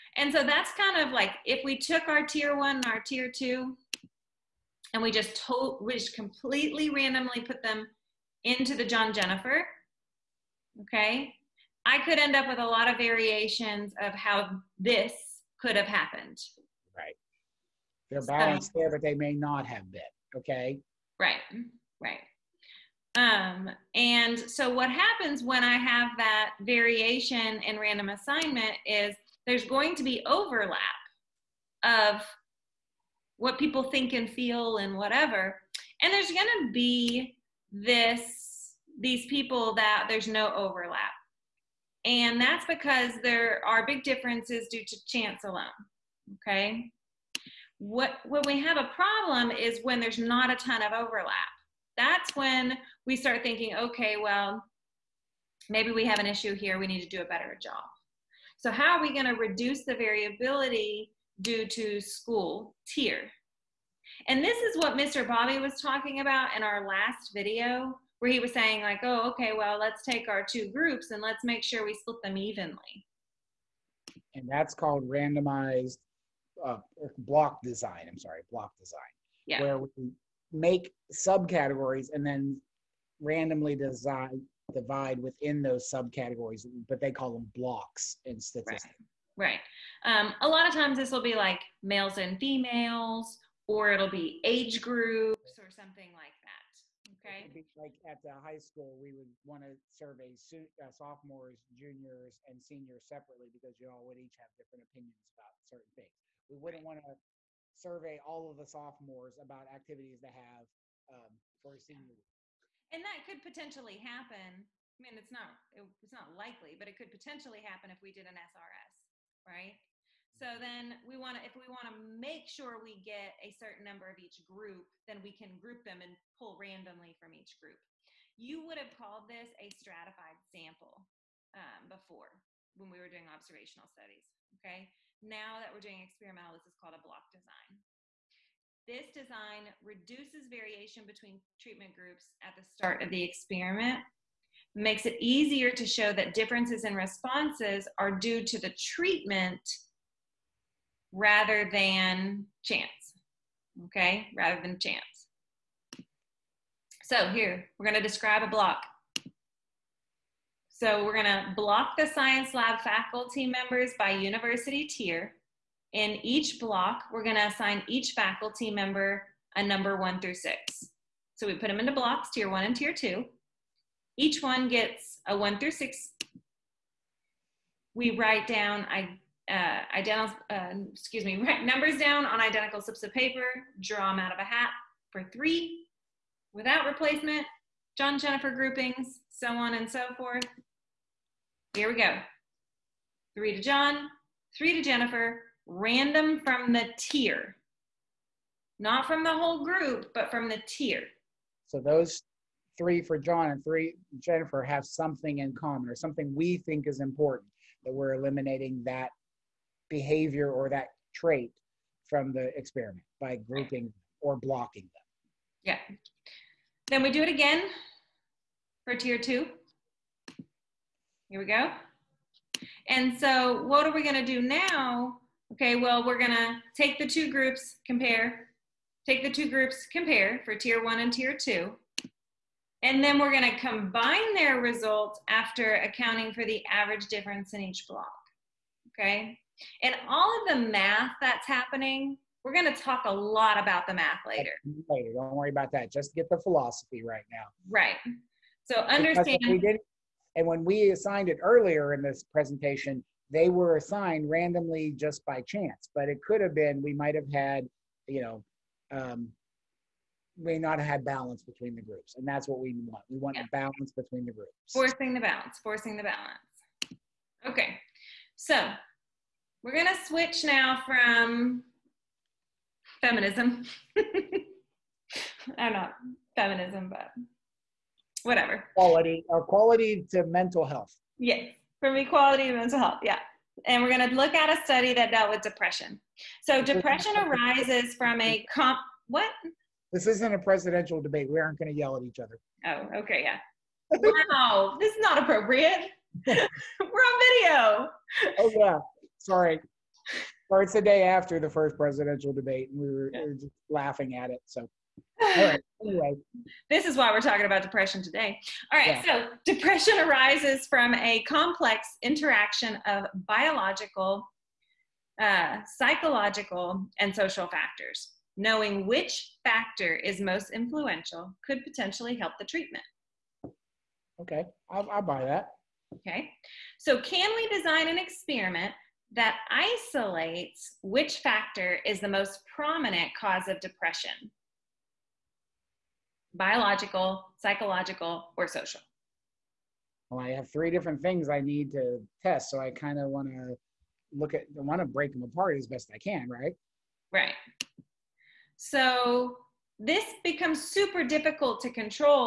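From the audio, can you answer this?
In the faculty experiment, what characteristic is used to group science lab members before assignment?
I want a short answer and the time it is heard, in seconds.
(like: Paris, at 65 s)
university tier, at 164 s.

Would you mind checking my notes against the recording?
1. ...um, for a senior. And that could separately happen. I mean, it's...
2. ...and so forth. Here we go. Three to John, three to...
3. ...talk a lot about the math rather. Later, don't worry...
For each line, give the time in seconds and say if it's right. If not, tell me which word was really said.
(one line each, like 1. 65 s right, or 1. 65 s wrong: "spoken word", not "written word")
1. 111 s wrong: "potentially", not "separately"
2. 189 s right
3. 242 s wrong: "later", not "rather".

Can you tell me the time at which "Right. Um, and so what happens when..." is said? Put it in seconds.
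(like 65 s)
22 s.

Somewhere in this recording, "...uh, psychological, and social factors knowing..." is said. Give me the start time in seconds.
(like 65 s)
315 s.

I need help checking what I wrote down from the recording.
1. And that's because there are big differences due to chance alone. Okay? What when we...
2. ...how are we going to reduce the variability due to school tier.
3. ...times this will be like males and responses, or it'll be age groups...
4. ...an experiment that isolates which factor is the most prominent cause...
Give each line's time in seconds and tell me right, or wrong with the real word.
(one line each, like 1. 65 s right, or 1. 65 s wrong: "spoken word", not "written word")
1. 42 s right
2. 58 s right
3. 90 s wrong: "females", not "responses"
4. 327 s right.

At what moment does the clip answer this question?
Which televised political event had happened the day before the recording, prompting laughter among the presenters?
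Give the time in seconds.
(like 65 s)
301 s.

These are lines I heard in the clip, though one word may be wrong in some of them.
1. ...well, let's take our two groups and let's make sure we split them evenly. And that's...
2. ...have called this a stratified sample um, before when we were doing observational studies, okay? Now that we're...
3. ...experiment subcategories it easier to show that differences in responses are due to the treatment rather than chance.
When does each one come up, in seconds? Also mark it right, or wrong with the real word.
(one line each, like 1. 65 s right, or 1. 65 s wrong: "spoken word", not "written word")
1. 69 s right
2. 128 s right
3. 143 s wrong: "makes", not "subcategories".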